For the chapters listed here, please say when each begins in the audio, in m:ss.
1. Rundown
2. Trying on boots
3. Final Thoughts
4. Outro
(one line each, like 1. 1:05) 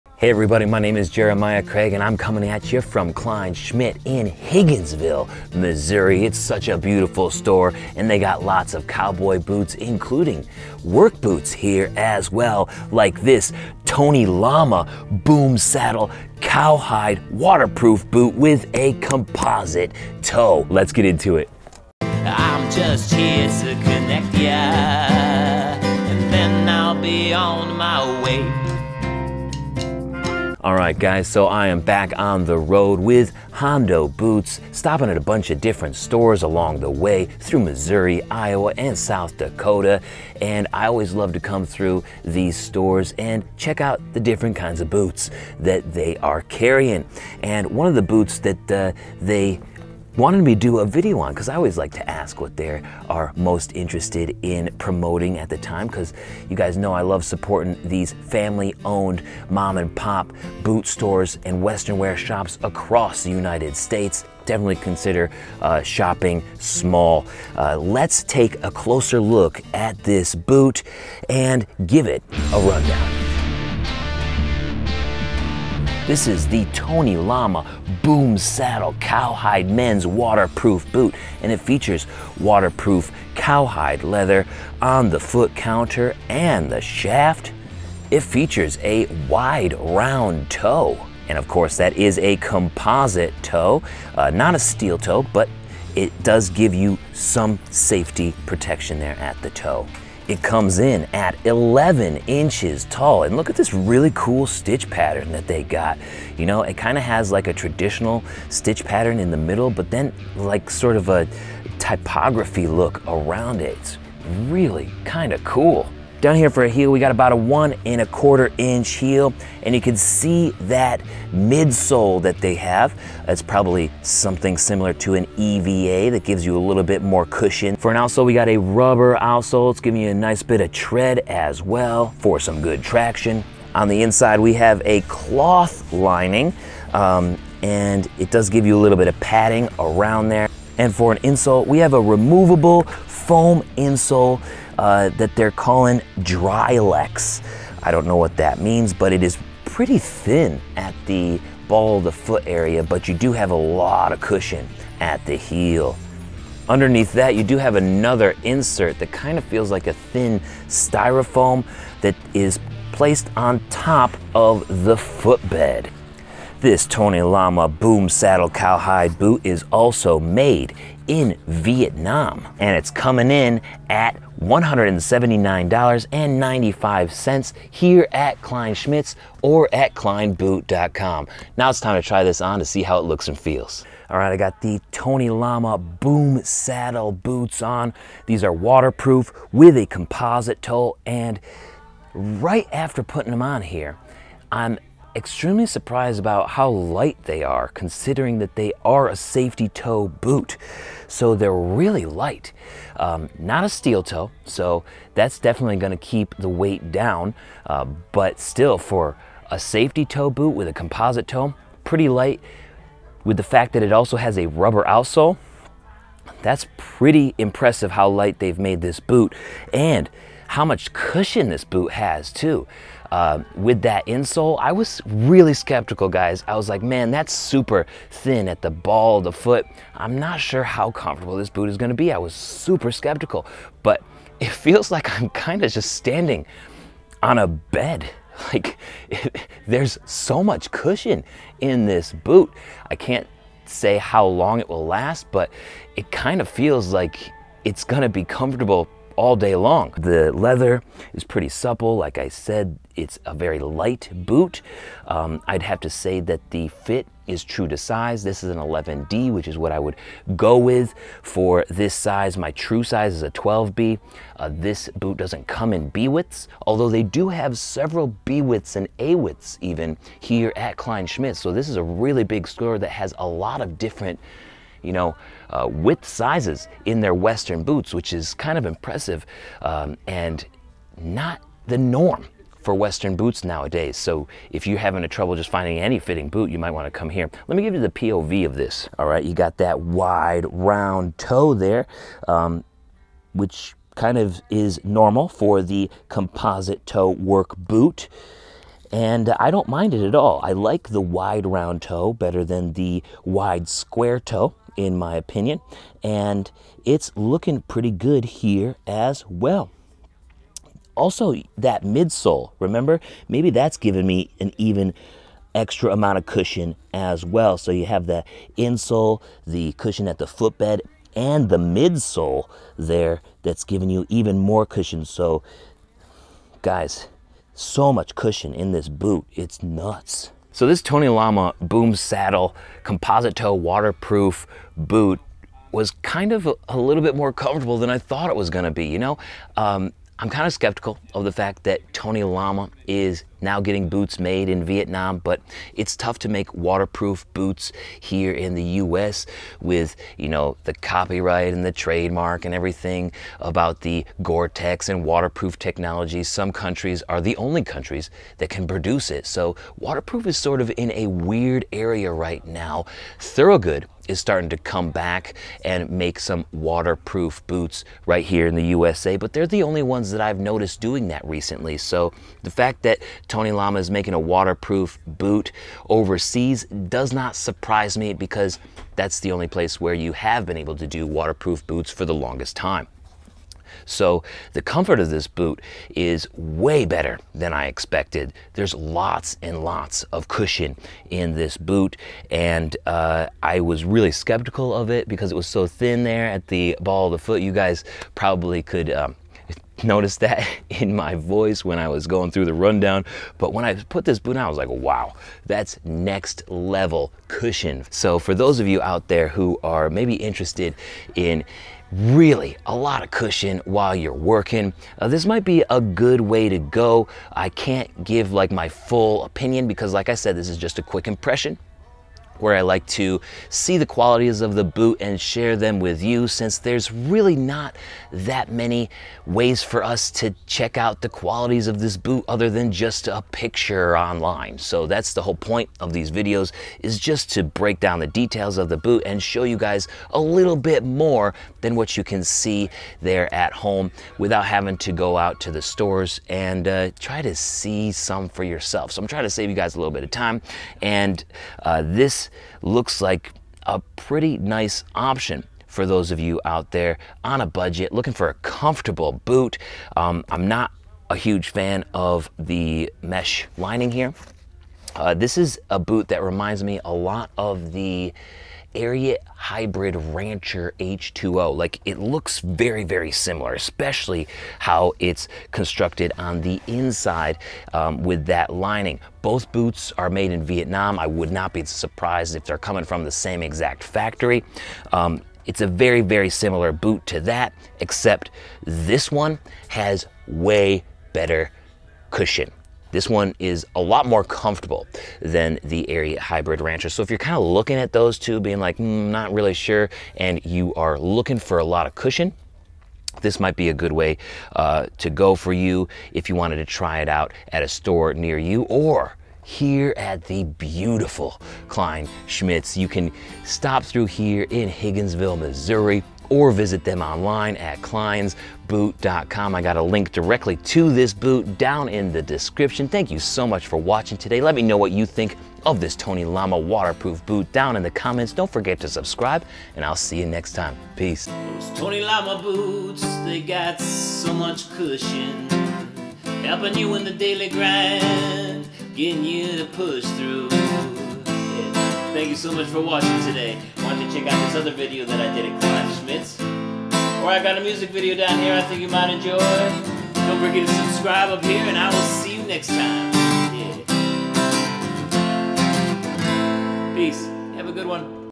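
1. 1:12
2. 3:03
3. 5:30
4. 8:30.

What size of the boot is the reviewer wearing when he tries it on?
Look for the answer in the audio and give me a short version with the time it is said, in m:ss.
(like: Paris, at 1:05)
11D, at 4:18.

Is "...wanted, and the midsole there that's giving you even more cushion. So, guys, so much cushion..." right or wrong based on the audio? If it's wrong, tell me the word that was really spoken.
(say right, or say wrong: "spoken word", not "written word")
wrong: "footbed", not "wanted".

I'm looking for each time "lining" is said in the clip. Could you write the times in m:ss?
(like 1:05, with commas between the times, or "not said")
2:15, 7:43, 7:58.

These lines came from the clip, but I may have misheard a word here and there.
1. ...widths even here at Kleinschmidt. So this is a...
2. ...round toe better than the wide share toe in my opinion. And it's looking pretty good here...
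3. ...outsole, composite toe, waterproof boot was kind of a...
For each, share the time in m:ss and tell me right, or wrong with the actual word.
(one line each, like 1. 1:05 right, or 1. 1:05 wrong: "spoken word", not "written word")
1. 4:29 right
2. 5:01 wrong: "square", not "share"
3. 5:31 wrong: "saddle", not "outsole".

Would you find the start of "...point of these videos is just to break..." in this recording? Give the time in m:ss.
7:15.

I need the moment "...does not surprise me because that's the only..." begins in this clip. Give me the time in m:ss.
6:16.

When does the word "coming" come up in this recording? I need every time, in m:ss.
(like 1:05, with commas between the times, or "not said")
0:02, 2:52, 8:02.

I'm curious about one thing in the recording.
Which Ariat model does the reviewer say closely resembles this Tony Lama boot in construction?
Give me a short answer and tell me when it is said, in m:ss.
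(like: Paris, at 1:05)
Hybrid Rancher H2O, at 7:49.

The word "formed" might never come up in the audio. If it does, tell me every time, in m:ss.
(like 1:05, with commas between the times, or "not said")
not said.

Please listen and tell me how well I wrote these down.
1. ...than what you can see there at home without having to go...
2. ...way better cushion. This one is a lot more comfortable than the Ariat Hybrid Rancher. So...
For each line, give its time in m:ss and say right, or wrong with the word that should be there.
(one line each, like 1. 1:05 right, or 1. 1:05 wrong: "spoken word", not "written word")
1. 7:21 right
2. 8:10 right.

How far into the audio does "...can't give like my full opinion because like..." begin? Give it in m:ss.
6:57.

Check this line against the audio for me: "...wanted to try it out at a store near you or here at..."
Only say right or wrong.
right.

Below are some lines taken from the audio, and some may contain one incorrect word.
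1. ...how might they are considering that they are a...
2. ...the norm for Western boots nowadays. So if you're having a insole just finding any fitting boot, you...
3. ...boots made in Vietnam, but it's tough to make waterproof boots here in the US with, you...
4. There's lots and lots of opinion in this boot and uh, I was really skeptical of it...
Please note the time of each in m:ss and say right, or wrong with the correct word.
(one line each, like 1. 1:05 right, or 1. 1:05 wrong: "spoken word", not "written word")
1. 3:16 wrong: "light", not "might"
2. 4:41 wrong: "trouble", not "insole"
3. 5:43 right
4. 6:28 wrong: "cushion", not "opinion".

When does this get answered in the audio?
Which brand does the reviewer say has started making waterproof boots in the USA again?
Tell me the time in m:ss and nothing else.
6:03.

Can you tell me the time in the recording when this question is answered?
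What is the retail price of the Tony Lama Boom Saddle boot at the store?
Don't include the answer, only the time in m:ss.
2:54.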